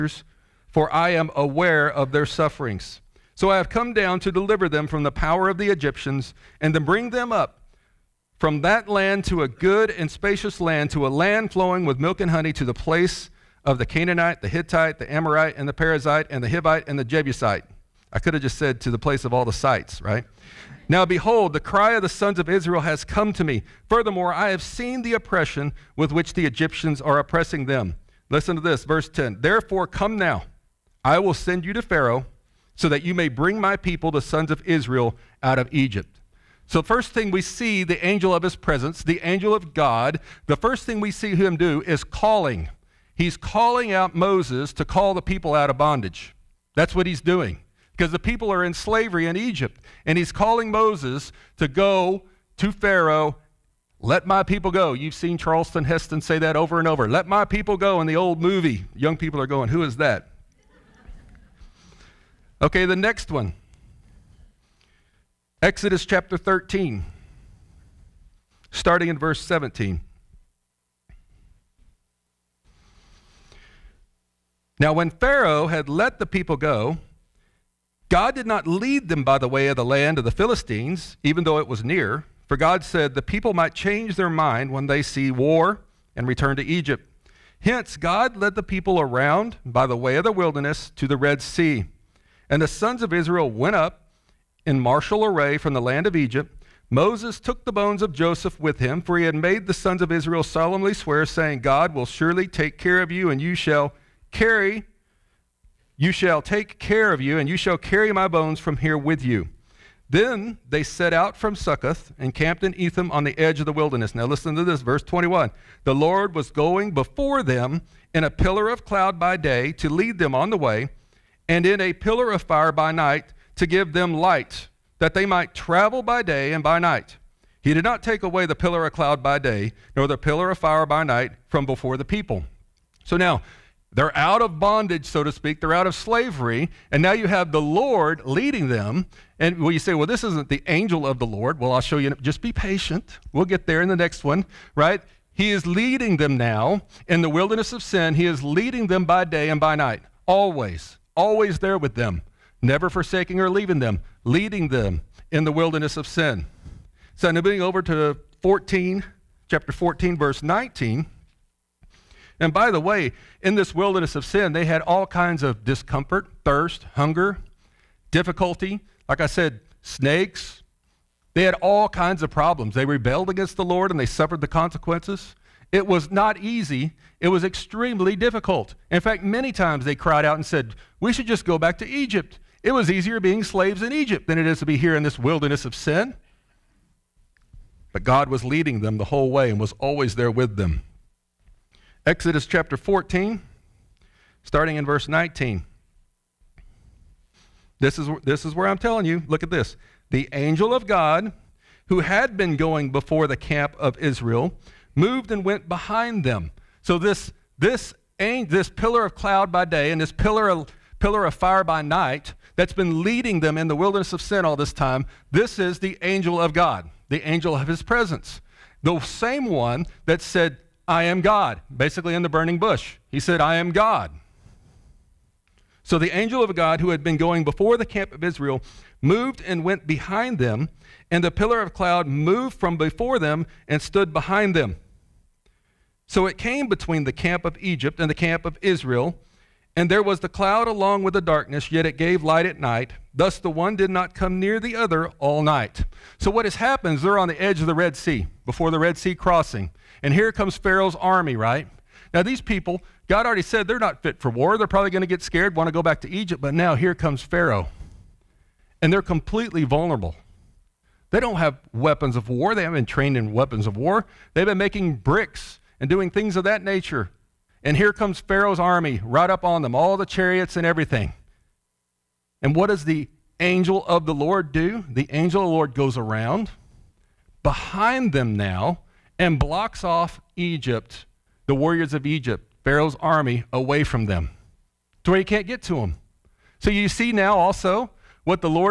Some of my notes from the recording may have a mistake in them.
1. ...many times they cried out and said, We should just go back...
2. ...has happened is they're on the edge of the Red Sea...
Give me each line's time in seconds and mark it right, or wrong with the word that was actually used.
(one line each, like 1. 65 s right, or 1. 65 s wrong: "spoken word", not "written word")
1. 179 s right
2. 246 s right.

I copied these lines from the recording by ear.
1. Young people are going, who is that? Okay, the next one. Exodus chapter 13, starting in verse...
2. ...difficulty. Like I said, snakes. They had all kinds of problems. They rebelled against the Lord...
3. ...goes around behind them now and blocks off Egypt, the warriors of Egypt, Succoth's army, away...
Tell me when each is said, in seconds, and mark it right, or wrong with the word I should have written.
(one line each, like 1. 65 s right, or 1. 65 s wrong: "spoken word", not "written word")
1. 58 s right
2. 168 s right
3. 275 s wrong: "Pharaoh", not "Succoth".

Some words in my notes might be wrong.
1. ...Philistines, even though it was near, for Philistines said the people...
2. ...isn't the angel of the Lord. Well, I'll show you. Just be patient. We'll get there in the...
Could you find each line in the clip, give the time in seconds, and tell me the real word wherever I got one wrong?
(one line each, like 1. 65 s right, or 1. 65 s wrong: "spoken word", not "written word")
1. 80 s wrong: "God", not "Philistines"
2. 140 s right.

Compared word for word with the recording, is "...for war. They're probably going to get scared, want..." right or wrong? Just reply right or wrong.
right.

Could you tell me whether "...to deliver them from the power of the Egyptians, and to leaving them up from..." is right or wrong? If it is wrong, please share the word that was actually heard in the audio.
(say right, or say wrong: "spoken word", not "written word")
wrong: "bring", not "leaving".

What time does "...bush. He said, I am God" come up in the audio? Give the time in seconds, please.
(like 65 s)
222 s.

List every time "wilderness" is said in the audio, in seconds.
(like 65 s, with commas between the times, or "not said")
90 s, 113 s, 147 s, 155 s, 163 s, 185 s, 213 s.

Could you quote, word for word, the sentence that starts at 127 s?
He did not take away the pillar of cloud by day, nor the pillar of fire by night from before the people.